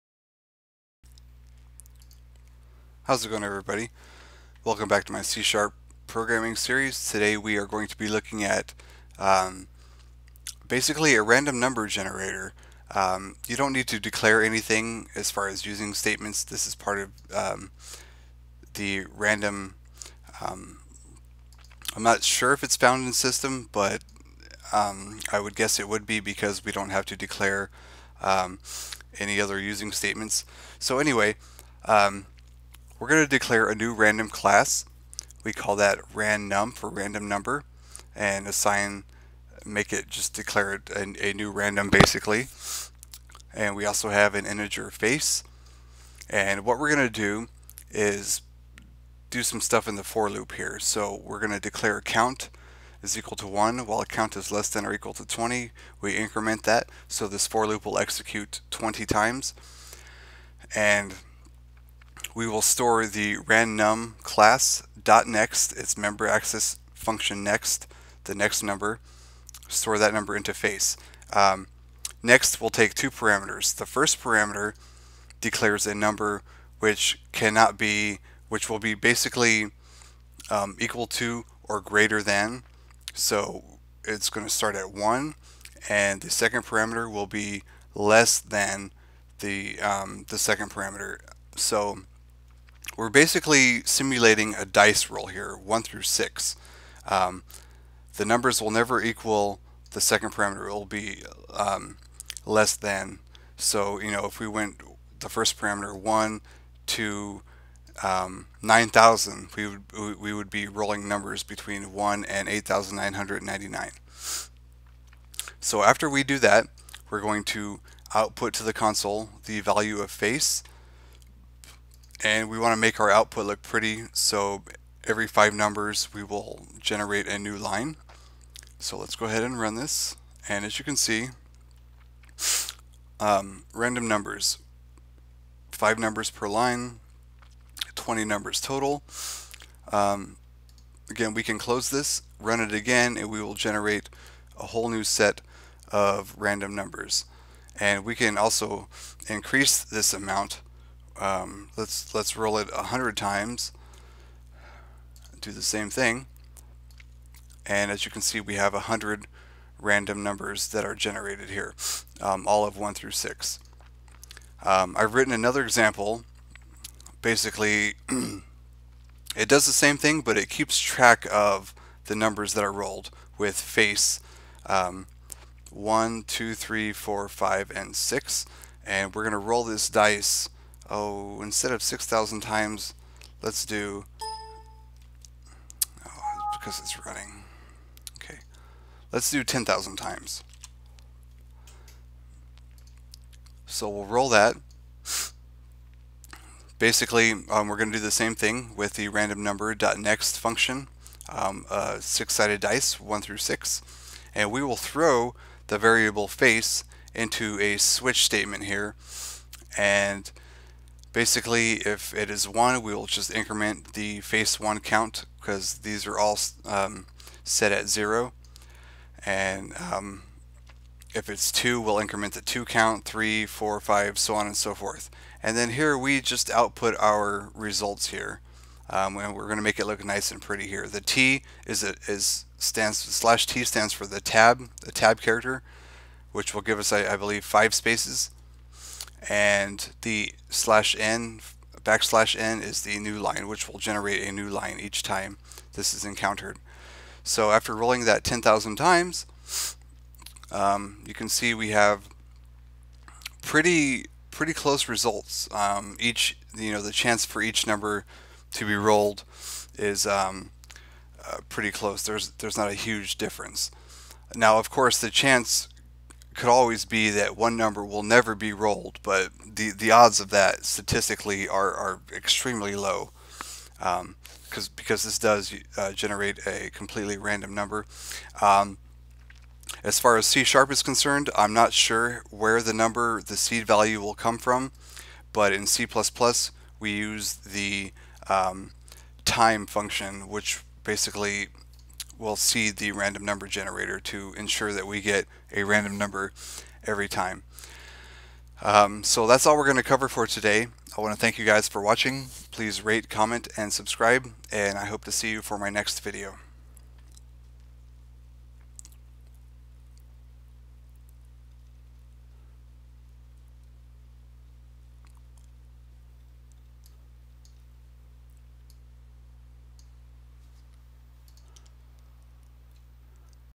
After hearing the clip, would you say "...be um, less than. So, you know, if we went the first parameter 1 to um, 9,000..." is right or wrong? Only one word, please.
right.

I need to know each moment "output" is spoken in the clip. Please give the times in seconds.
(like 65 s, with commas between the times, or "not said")
118 s, 123 s, 226 s.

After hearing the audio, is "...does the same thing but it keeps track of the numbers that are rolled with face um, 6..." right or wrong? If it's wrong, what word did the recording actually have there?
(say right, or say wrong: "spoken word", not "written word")
wrong: "1", not "6".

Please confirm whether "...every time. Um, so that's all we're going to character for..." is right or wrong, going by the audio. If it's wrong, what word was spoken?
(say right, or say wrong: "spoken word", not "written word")
wrong: "cover", not "character".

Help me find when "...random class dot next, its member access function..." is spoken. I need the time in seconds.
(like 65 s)
63 s.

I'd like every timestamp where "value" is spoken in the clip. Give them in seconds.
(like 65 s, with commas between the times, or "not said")
119 s, 283 s.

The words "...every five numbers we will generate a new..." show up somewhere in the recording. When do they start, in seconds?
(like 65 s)
125 s.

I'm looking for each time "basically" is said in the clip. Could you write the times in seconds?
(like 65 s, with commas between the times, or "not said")
10 s, 41 s, 78 s, 93 s, 167 s, 196 s, 211 s, 290 s.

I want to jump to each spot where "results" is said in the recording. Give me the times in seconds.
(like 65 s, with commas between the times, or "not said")
227 s, 254 s.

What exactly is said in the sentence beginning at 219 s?
And um, if it's 2, we'll increment the 2 count, 3, 4, 5, so on and so forth.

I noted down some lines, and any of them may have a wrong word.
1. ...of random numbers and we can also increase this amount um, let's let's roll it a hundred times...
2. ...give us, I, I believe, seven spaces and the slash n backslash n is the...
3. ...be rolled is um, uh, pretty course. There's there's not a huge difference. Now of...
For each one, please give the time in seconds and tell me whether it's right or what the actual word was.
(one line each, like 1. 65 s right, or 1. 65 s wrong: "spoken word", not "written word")
1. 145 s right
2. 236 s wrong: "five", not "seven"
3. 258 s wrong: "close", not "course".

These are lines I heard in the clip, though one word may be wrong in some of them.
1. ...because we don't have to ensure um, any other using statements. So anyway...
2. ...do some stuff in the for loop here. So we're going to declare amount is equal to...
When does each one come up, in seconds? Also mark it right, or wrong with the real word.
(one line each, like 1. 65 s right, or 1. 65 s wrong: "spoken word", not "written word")
1. 26 s wrong: "declare", not "ensure"
2. 49 s wrong: "count", not "amount".